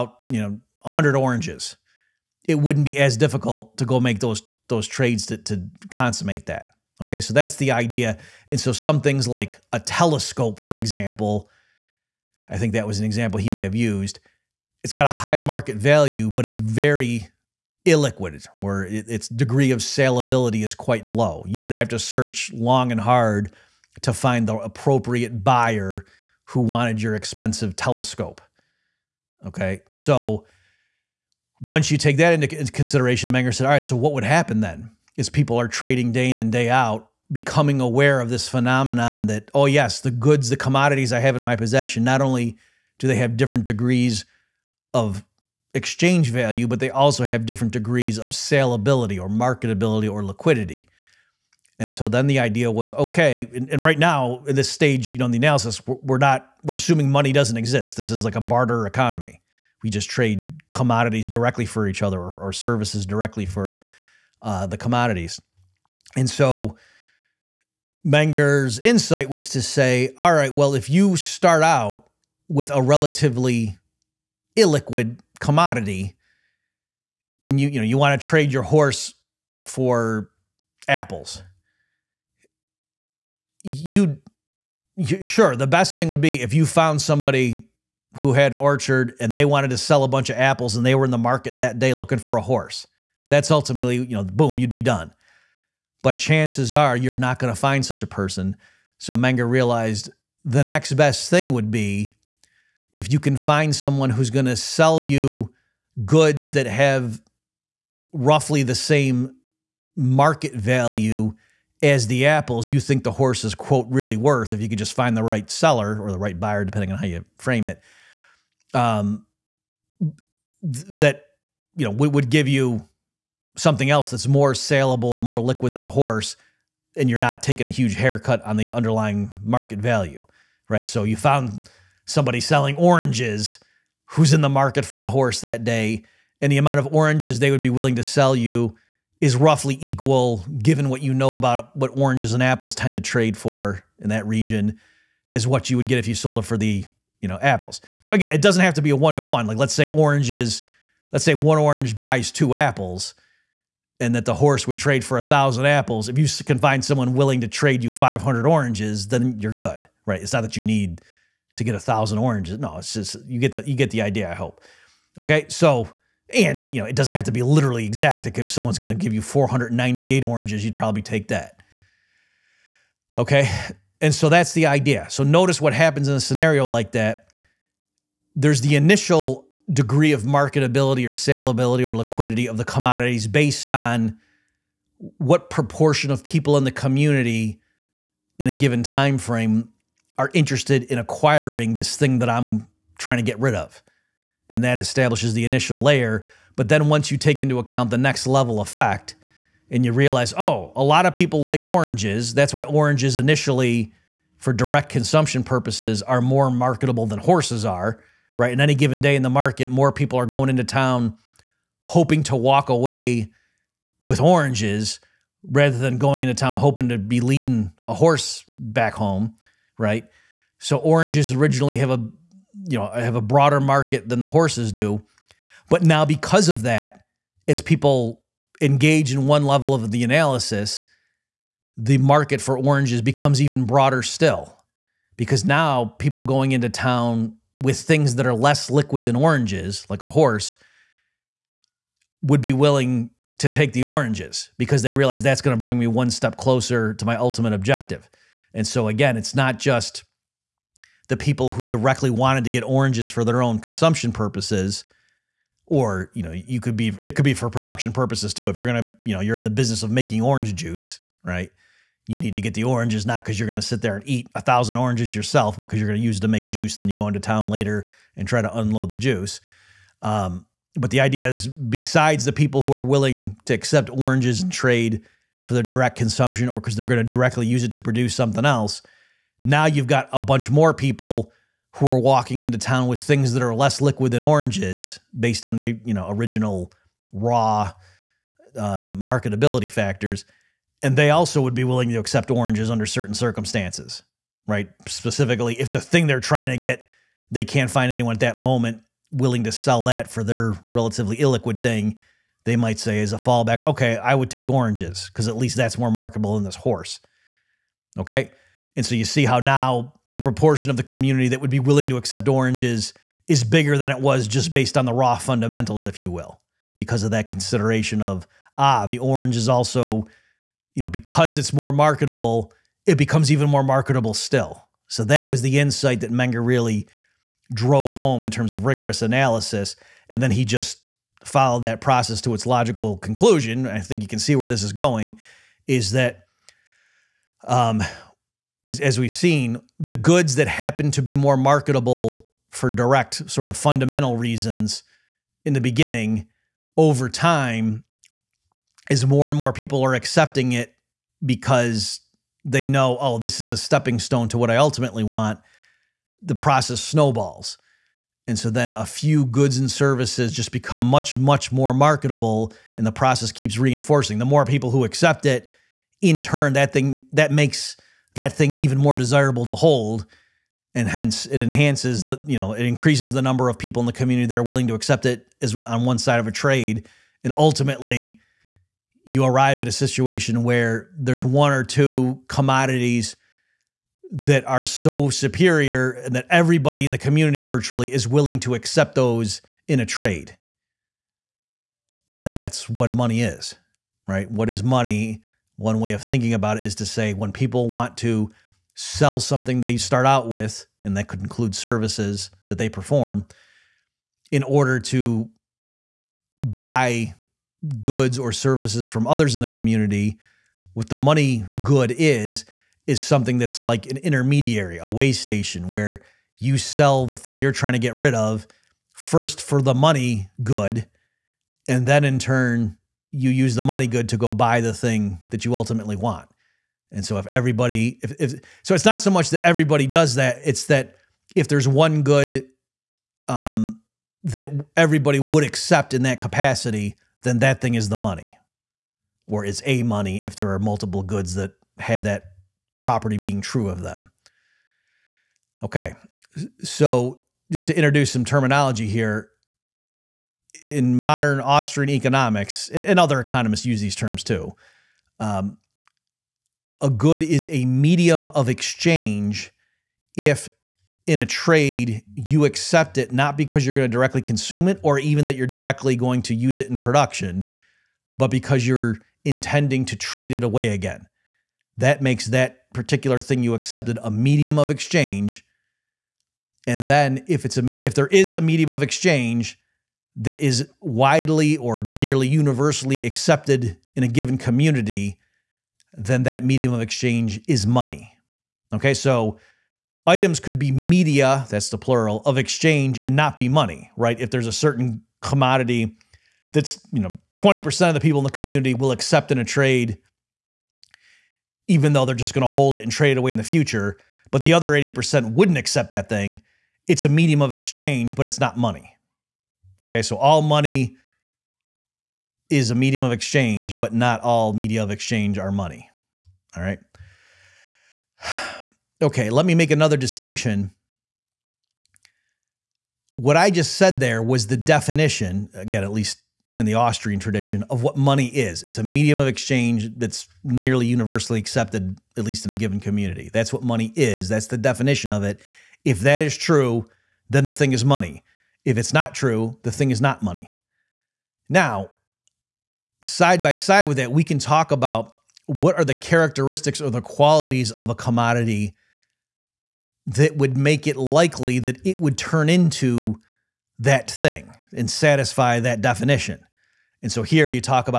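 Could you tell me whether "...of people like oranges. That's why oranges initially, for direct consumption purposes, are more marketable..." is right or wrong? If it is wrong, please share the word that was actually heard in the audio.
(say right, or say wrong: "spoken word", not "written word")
right.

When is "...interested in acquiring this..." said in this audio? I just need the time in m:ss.
3:10.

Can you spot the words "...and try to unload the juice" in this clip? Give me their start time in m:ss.
4:28.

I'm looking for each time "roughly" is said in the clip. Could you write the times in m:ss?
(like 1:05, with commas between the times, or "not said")
1:48, 2:19.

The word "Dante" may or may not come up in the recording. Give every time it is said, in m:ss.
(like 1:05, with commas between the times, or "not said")
not said.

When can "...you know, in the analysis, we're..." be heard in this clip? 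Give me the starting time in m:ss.
0:55.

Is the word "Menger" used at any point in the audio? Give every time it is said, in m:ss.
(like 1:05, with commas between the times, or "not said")
0:33, 1:08, 1:39, 5:26.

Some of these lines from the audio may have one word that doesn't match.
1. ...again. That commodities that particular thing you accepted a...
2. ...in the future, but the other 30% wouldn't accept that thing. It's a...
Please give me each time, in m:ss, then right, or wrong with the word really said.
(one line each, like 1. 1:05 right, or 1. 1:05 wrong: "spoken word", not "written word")
1. 7:50 wrong: "makes", not "commodities"
2. 8:23 wrong: "80", not "30".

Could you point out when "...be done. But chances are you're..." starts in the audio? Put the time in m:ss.
1:34.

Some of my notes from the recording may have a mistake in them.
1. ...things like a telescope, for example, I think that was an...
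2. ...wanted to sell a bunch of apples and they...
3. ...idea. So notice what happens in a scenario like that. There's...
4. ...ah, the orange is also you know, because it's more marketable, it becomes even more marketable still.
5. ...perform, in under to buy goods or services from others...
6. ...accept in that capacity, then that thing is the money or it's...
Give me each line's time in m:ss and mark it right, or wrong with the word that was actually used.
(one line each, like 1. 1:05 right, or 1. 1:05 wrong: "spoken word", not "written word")
1. 0:09 right
2. 1:29 right
3. 2:54 right
4. 5:18 right
5. 6:42 wrong: "order", not "under"
6. 7:15 right.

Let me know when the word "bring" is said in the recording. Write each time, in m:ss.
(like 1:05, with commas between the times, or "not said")
4:05.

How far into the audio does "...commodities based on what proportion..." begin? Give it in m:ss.
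3:02.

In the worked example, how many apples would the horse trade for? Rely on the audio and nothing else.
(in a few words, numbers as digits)
1000.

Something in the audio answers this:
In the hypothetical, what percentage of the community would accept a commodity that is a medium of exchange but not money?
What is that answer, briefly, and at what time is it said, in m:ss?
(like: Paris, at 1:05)
20%, at 8:17.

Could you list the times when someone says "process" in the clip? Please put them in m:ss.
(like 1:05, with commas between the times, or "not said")
5:31, 5:56, 6:02.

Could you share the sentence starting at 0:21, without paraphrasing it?
You would have to search long and hard to find the appropriate buyer who wanted your expensive telescope.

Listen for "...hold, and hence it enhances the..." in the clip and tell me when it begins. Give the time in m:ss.
6:09.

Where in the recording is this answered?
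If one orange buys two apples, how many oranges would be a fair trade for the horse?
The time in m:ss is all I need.
2:37.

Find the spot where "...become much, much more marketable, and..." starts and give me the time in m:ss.
6:00.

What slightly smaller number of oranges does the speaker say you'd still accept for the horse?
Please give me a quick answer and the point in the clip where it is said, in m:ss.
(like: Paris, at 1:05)
498, at 2:49.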